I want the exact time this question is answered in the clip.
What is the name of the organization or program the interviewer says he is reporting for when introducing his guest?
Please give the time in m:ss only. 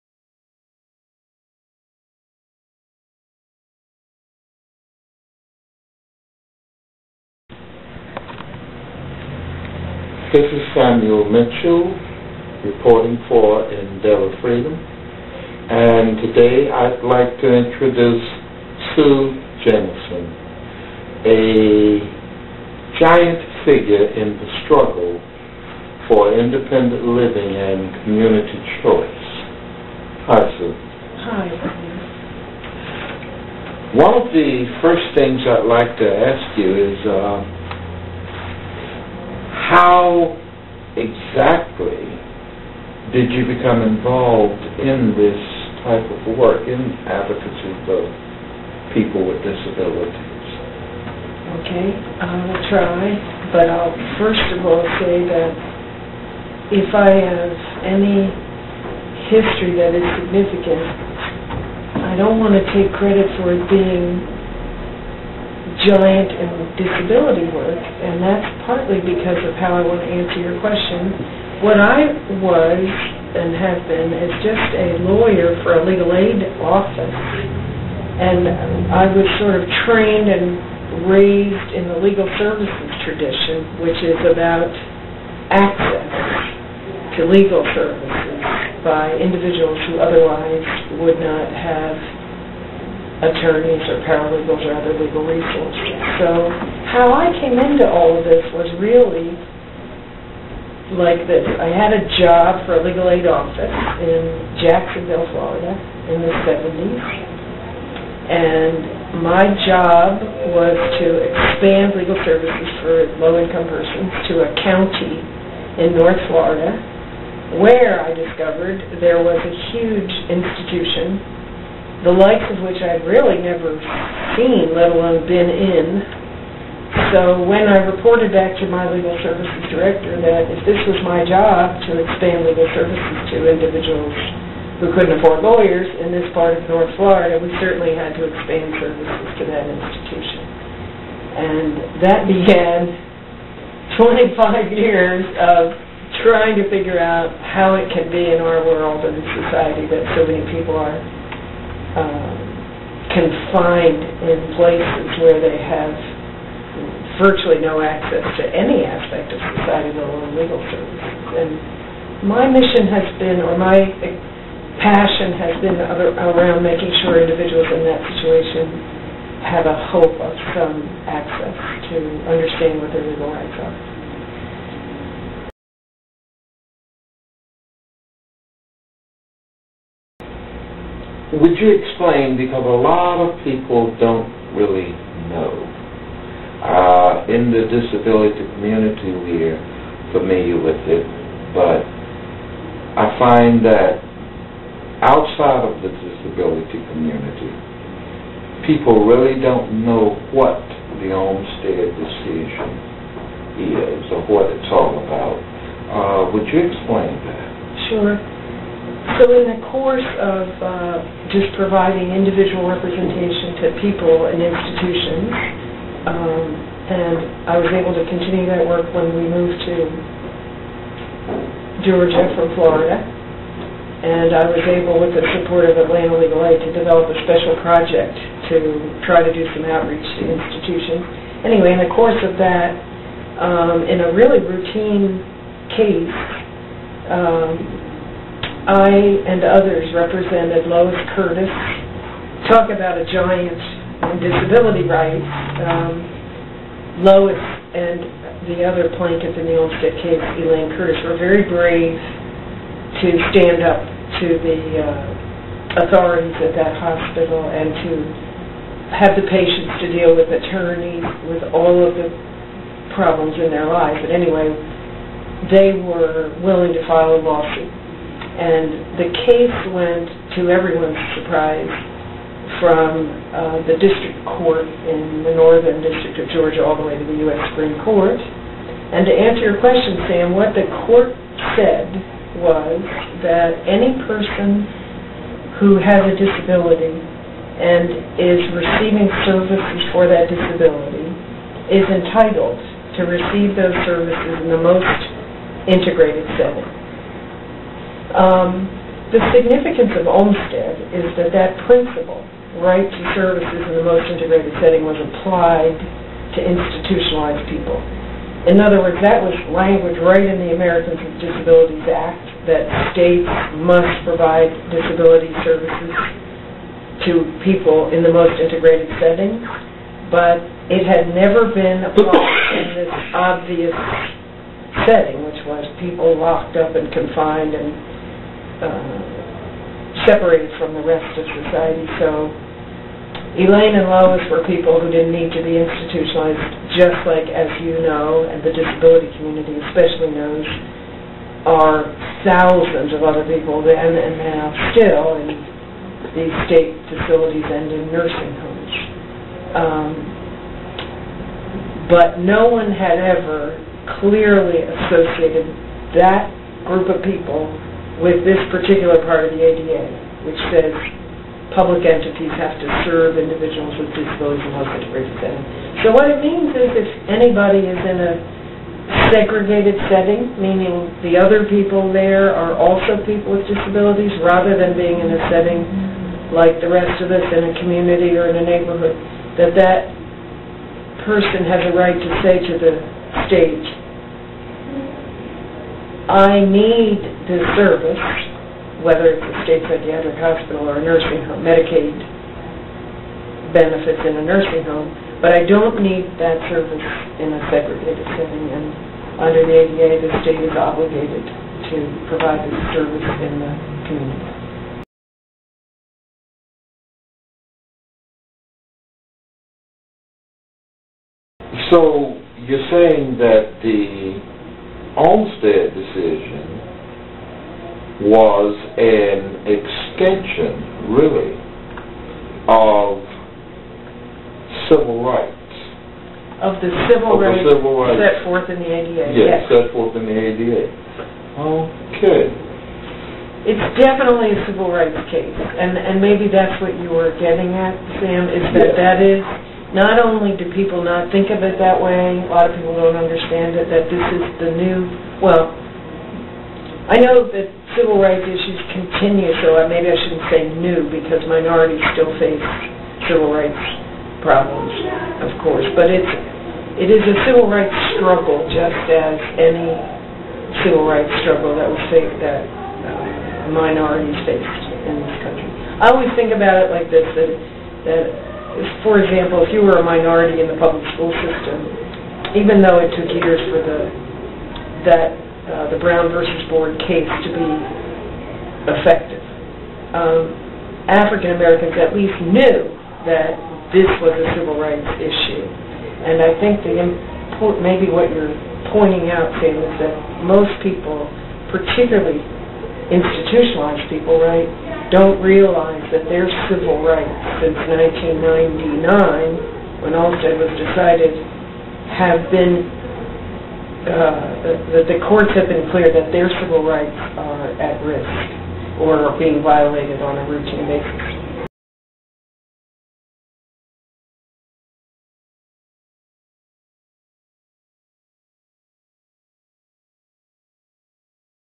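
0:13.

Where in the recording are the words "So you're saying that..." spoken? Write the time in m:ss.
6:51.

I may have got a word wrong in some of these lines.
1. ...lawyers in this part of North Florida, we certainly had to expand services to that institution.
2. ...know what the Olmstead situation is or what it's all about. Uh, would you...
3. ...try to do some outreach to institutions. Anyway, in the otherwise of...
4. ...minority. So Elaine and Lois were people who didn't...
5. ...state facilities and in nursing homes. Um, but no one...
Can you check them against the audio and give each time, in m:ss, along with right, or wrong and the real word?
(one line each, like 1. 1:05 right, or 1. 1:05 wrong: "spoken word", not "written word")
1. 2:15 right
2. 3:19 wrong: "decision", not "situation"
3. 3:49 wrong: "course", not "otherwise"
4. 5:31 wrong: "society", not "minority"
5. 5:46 right.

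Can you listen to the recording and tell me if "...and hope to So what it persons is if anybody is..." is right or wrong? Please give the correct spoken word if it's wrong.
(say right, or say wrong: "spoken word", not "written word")
wrong: "means", not "persons".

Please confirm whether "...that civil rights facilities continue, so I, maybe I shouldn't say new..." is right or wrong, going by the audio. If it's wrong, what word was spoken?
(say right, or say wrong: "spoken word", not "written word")
wrong: "issues", not "facilities".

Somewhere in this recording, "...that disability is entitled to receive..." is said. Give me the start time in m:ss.
4:50.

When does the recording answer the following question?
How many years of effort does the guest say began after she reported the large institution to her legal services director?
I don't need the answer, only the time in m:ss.
2:24.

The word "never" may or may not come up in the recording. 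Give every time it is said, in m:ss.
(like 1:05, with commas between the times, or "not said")
2:03, 5:21.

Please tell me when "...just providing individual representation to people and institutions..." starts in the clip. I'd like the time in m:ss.
3:31.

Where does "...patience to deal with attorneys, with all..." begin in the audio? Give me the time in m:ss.
4:19.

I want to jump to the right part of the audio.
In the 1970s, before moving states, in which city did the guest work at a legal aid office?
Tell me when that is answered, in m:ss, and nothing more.
1:44.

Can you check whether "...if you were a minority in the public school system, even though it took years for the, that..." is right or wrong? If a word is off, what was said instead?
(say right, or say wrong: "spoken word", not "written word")
right.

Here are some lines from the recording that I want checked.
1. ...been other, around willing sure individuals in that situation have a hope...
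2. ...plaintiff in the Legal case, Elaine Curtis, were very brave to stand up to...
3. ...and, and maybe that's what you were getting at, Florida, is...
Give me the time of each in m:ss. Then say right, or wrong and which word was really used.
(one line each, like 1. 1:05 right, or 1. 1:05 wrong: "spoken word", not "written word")
1. 2:45 wrong: "making", not "willing"
2. 4:09 wrong: "Olmstead", not "Legal"
3. 7:15 wrong: "Sam", not "Florida".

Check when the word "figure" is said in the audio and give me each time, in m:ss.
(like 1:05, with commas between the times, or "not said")
0:23, 2:26.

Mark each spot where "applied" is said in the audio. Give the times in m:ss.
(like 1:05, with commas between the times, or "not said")
5:04, 5:21.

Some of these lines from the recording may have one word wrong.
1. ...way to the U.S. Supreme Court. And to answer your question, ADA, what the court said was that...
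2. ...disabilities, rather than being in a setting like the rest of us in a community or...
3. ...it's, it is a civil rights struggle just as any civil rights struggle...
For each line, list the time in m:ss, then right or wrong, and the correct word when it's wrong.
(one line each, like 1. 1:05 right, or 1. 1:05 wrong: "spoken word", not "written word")
1. 4:36 wrong: "Sam", not "ADA"
2. 6:13 right
3. 7:35 right.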